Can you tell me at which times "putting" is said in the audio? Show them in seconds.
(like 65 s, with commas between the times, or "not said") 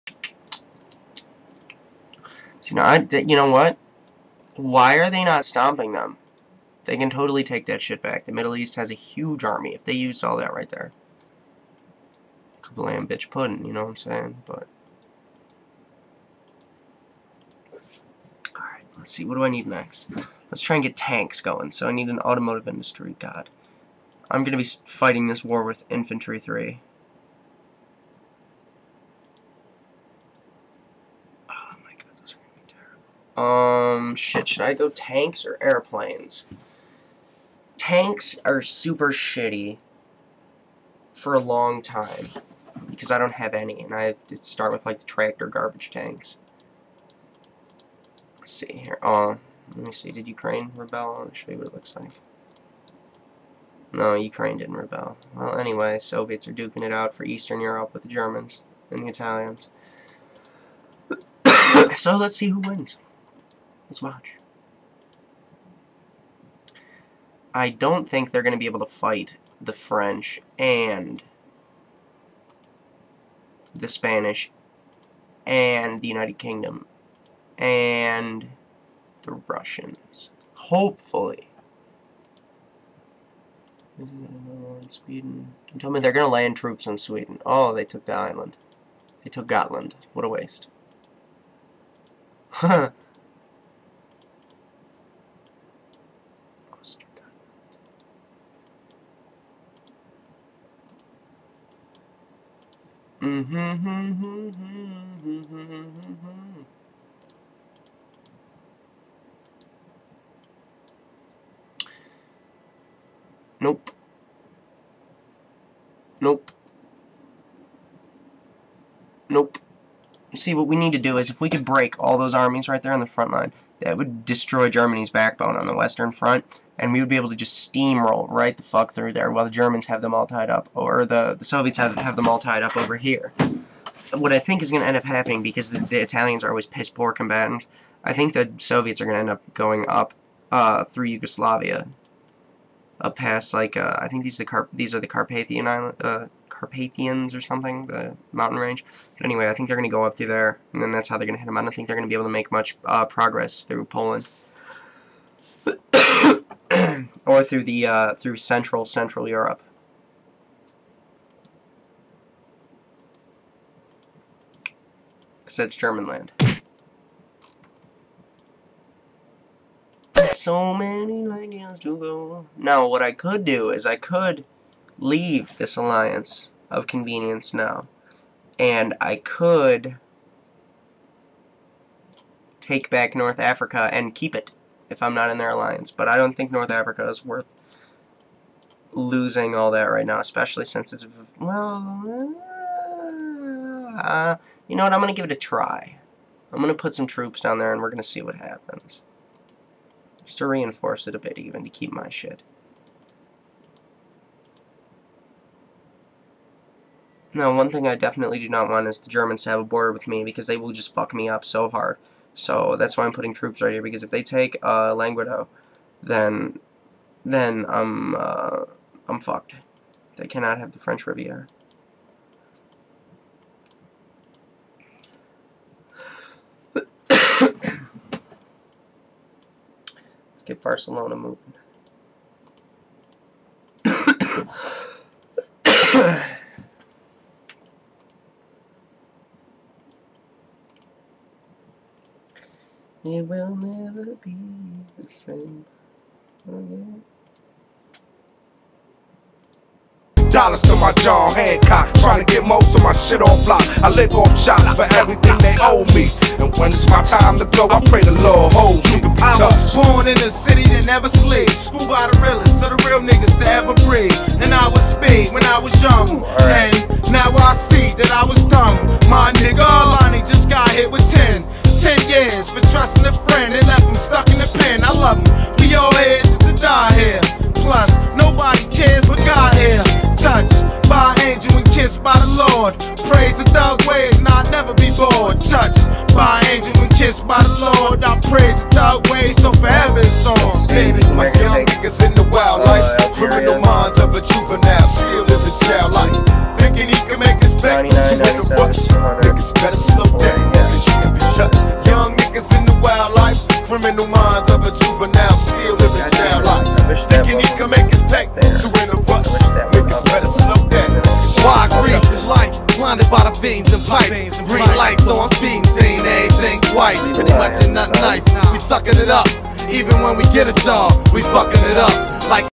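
213 s.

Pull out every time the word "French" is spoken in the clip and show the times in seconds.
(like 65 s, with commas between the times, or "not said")
69 s, 220 s.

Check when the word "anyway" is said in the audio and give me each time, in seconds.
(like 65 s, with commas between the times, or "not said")
55 s, 149 s.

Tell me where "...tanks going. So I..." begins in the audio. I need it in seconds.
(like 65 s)
20 s.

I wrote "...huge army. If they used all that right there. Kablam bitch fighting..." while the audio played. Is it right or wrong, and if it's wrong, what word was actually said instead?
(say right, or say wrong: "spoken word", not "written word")
wrong: "pudding", not "fighting".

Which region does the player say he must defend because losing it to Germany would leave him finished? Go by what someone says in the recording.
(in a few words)
Languedoc.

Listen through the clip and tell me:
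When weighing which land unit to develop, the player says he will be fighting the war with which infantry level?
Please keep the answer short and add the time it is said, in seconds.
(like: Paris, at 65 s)
Infantry 3, at 25 s.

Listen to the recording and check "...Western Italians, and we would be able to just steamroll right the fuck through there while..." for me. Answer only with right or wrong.
wrong.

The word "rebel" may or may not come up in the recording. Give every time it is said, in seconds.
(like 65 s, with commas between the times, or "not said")
50 s, 54 s.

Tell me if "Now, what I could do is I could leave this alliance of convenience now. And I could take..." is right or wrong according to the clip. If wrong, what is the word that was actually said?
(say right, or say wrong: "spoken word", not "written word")
right.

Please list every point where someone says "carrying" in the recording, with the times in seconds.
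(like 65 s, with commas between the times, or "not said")
not said.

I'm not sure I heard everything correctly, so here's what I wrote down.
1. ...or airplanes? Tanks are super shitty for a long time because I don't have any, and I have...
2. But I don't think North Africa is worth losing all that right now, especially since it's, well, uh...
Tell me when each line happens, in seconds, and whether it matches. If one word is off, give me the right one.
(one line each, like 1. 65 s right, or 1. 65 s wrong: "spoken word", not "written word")
1. 35 s right
2. 185 s right.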